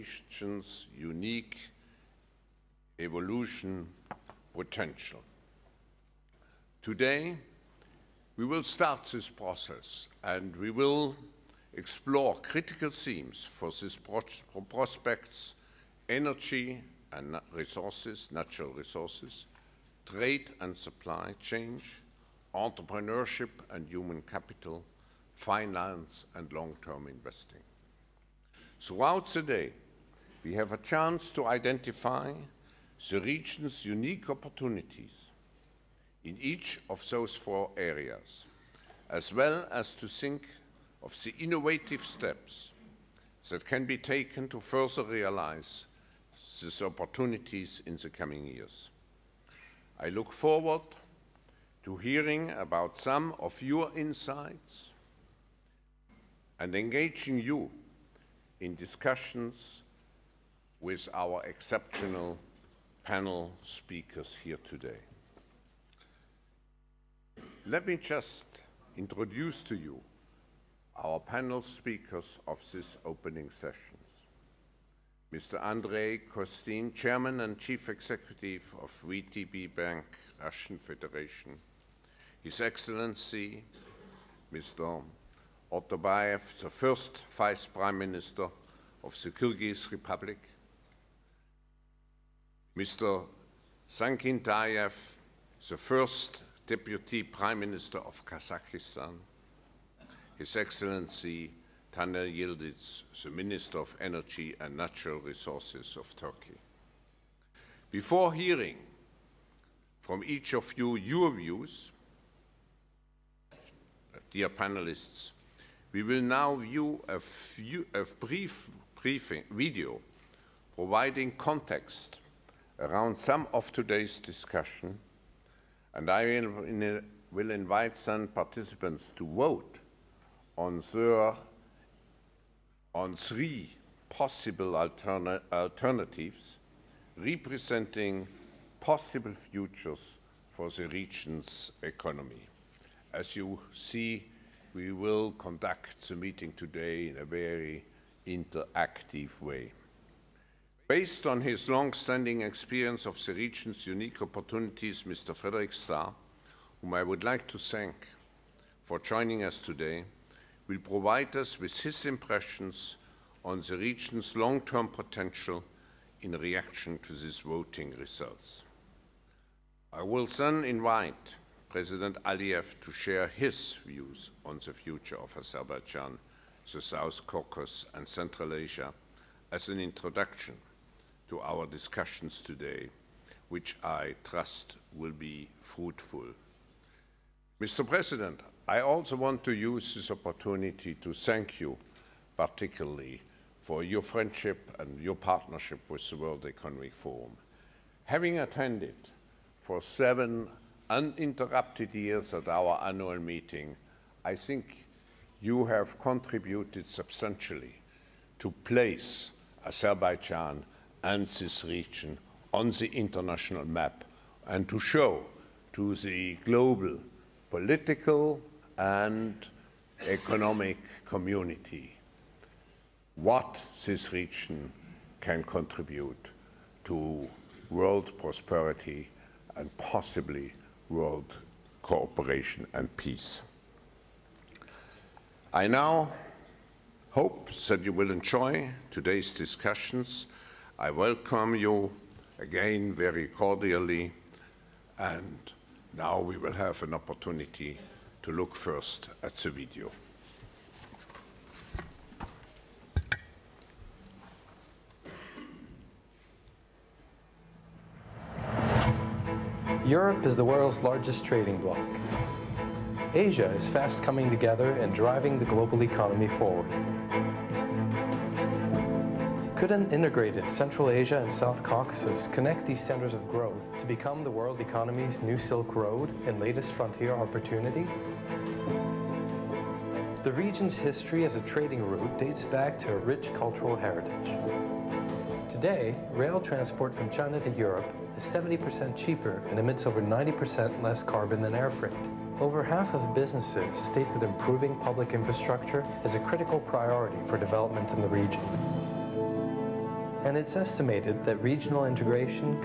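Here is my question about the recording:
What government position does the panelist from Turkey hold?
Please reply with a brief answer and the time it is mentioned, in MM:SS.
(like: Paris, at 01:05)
Minister of Energy and Natural Resources, at 01:43.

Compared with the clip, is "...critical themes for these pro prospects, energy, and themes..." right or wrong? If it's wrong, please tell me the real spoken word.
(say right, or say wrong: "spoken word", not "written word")
wrong: "resources", not "themes".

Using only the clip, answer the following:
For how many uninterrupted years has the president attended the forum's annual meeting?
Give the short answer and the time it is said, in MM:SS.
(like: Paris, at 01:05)
7, at 03:19.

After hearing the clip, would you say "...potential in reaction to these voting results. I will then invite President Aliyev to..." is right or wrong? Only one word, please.
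right.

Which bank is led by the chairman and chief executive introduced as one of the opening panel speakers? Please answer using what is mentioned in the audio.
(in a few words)
VTB Bank.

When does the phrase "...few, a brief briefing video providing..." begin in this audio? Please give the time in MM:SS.
01:57.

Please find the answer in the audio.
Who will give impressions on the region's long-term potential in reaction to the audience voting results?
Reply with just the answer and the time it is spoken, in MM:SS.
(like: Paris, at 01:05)
Frederick Starr, at 02:35.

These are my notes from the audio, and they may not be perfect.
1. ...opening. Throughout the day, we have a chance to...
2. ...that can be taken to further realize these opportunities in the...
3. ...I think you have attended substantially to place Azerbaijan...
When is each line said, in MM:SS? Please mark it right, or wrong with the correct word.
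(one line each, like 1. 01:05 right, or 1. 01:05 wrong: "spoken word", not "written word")
1. 00:27 wrong: "investing", not "opening"
2. 00:43 right
3. 03:24 wrong: "contributed", not "attended".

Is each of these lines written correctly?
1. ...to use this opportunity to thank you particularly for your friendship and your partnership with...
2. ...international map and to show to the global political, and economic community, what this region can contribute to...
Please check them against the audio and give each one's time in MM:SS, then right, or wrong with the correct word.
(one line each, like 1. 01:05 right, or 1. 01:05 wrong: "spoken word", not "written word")
1. 03:09 right
2. 03:32 right.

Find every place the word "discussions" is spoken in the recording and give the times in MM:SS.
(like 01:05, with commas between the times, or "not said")
00:58, 02:04, 03:01, 03:59.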